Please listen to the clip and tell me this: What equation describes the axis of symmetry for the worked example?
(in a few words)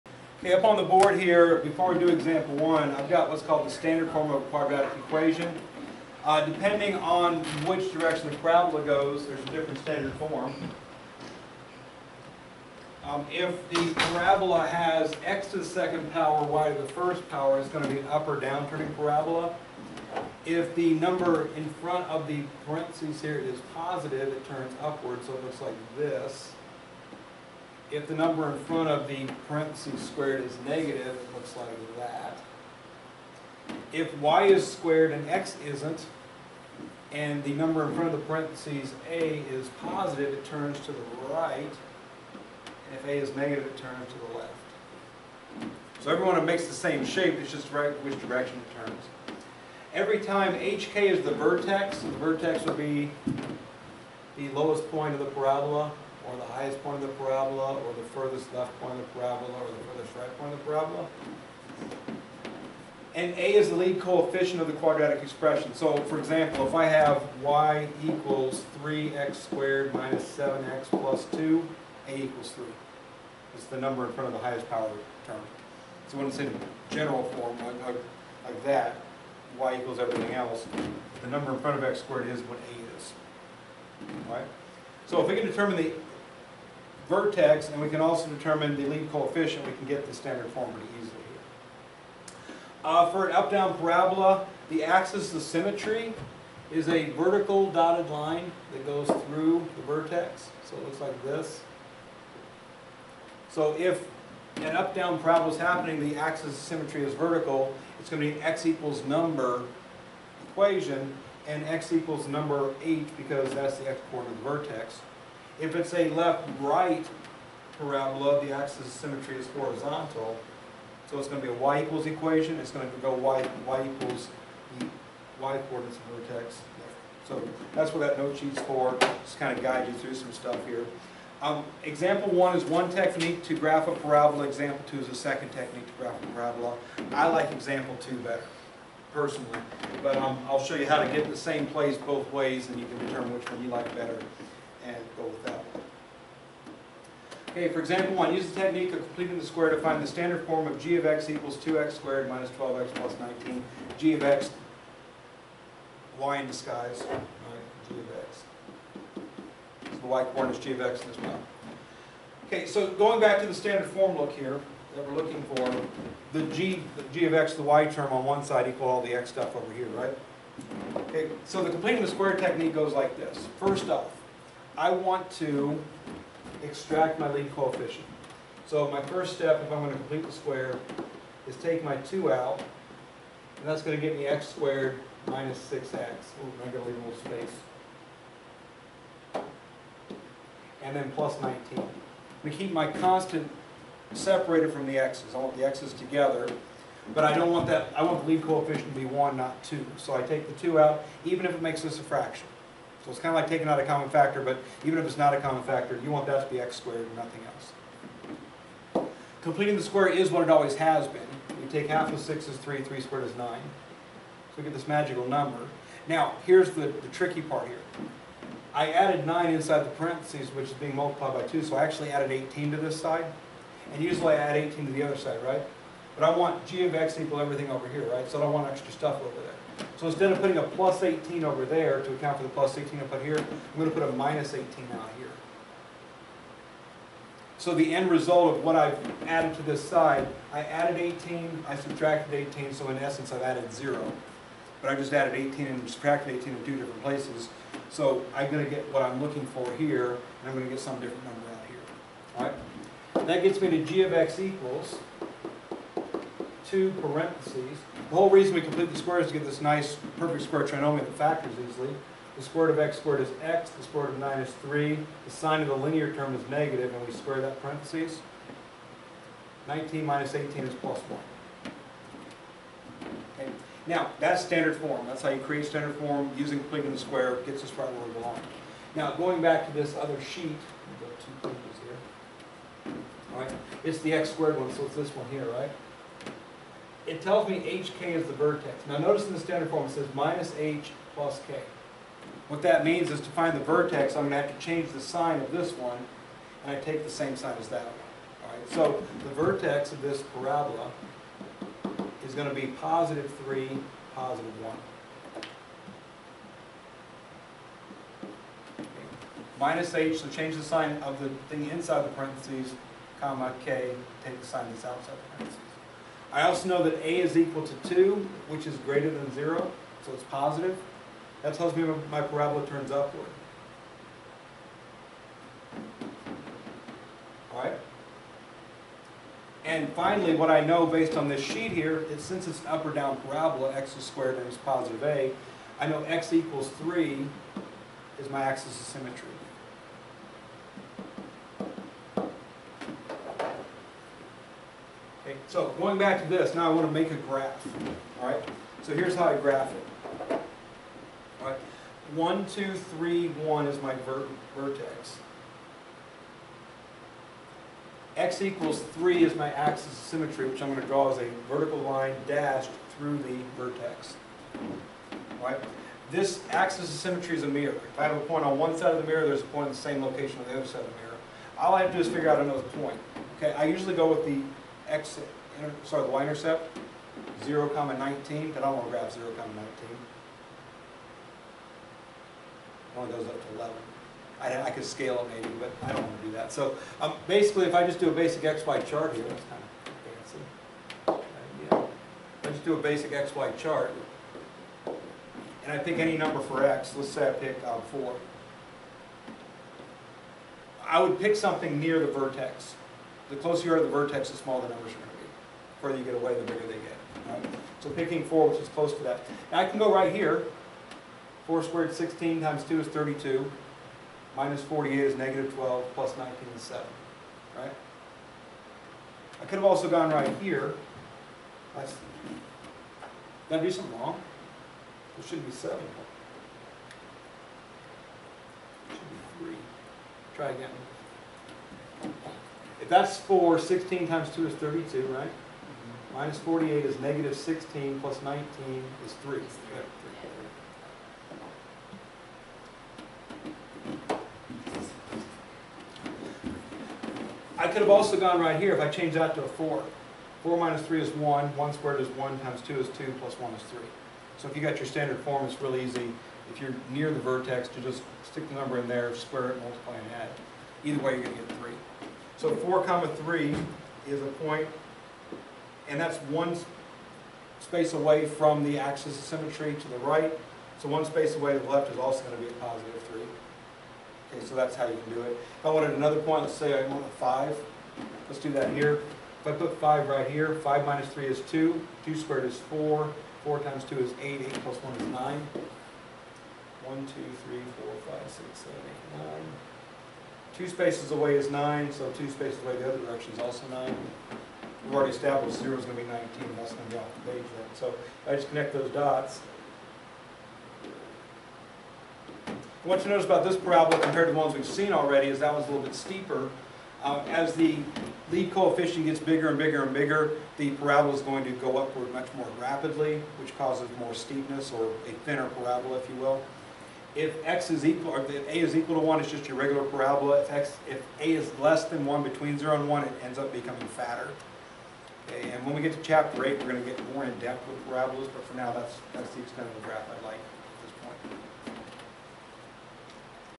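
x = 3.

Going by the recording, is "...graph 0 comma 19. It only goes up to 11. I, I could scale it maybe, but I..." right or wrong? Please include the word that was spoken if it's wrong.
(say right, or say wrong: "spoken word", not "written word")
right.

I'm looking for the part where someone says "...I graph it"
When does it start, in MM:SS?
05:49.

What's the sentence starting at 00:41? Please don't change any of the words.
And if a is negative, it turns to the left.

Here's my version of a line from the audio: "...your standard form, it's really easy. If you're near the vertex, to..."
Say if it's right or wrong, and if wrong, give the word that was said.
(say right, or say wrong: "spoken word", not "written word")
right.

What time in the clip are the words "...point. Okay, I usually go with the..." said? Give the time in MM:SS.
06:12.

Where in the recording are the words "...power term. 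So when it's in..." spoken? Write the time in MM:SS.
01:14.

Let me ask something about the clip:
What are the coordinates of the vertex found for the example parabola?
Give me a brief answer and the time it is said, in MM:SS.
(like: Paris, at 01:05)
(3, 1), at 05:02.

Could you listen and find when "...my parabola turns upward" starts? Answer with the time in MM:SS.
05:22.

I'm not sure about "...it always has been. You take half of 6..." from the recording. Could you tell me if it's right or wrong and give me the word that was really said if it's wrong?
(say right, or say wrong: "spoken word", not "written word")
right.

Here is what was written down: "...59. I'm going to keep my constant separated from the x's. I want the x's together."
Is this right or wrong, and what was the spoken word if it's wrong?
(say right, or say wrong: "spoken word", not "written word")
wrong: "19", not "59".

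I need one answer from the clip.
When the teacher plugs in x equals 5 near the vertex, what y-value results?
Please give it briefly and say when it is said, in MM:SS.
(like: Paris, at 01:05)
9, at 08:04.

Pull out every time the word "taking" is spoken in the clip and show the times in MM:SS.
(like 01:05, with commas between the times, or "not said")
03:23.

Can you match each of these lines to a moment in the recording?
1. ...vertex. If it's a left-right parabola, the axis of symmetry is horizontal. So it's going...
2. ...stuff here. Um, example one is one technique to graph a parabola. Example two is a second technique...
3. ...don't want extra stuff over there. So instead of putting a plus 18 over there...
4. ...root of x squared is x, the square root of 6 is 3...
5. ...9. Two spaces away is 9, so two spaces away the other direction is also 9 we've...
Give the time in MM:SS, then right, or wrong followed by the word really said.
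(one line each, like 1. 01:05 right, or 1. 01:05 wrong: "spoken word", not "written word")
1. 01:54 right
2. 02:10 right
3. 03:48 right
4. 04:22 wrong: "9", not "6"
5. 08:09 right.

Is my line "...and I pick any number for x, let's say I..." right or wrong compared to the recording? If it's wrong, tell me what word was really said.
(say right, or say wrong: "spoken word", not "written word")
right.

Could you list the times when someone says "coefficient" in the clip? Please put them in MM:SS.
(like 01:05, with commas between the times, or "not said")
01:03, 01:29, 02:57, 03:18, 08:28.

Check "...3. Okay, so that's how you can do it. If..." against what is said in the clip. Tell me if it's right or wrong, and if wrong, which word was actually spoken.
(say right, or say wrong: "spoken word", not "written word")
right.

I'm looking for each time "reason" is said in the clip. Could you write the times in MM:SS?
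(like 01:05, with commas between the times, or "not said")
04:18.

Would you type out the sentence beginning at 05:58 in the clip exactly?
X equals three is my axis of symmetry, which I'm going to draw as a vertical line dashed through the vertex.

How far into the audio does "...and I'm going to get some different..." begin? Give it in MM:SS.
04:10.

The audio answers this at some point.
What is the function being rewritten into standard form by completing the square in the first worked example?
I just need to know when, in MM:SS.
02:31.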